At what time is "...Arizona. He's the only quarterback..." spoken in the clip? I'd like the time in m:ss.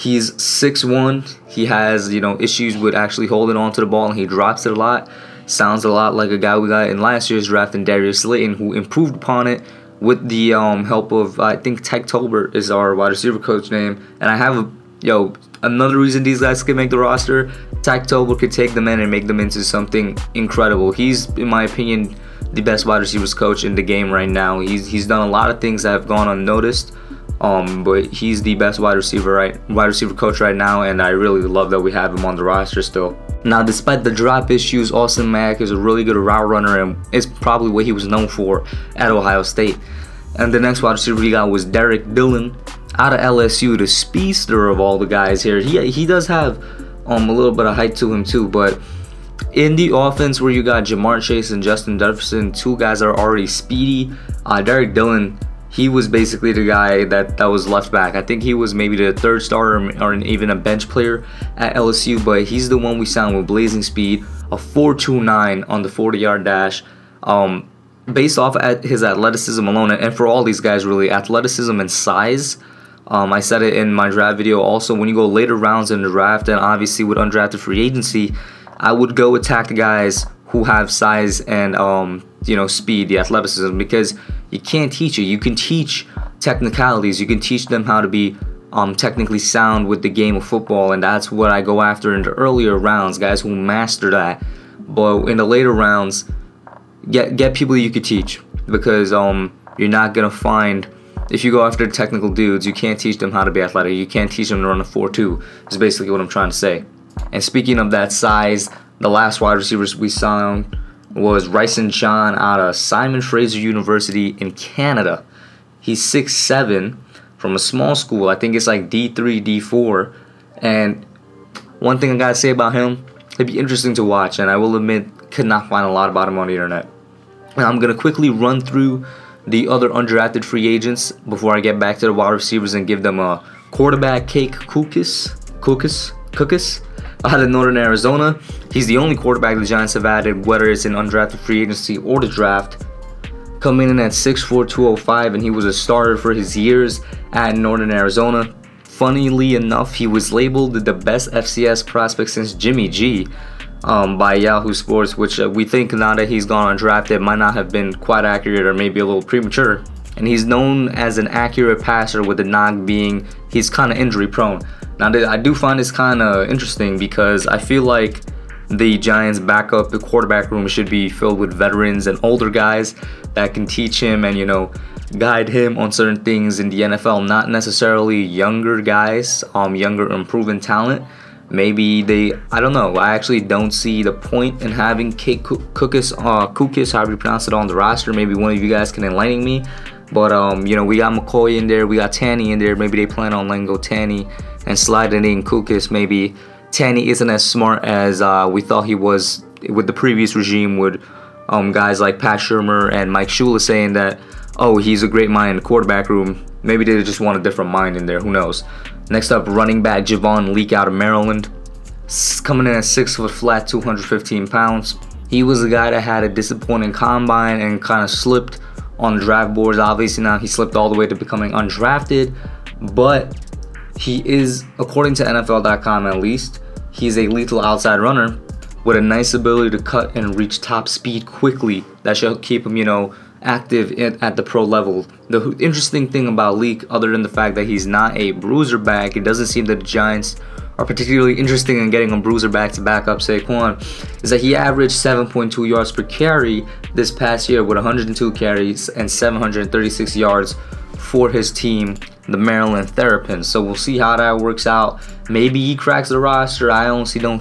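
2:17.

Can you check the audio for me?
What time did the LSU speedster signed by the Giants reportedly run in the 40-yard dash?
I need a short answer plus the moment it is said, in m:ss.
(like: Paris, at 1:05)
4.29, at 1:04.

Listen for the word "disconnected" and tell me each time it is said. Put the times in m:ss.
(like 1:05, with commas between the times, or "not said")
not said.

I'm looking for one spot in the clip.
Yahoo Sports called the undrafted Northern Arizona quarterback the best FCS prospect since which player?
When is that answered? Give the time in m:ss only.
2:32.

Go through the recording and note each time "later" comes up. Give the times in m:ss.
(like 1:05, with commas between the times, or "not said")
1:15, 1:35.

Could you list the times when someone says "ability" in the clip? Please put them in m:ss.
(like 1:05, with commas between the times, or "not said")
3:49.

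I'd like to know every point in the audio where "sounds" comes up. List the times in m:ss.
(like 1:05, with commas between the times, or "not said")
0:05, 1:29.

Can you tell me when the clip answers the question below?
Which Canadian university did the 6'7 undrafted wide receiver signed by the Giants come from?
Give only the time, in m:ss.
1:52.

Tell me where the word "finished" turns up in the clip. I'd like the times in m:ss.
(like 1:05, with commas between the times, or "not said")
not said.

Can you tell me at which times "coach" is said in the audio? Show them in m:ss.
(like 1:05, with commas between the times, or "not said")
0:13, 0:23, 0:30.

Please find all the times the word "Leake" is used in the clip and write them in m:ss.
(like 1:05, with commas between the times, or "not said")
3:30, 3:56.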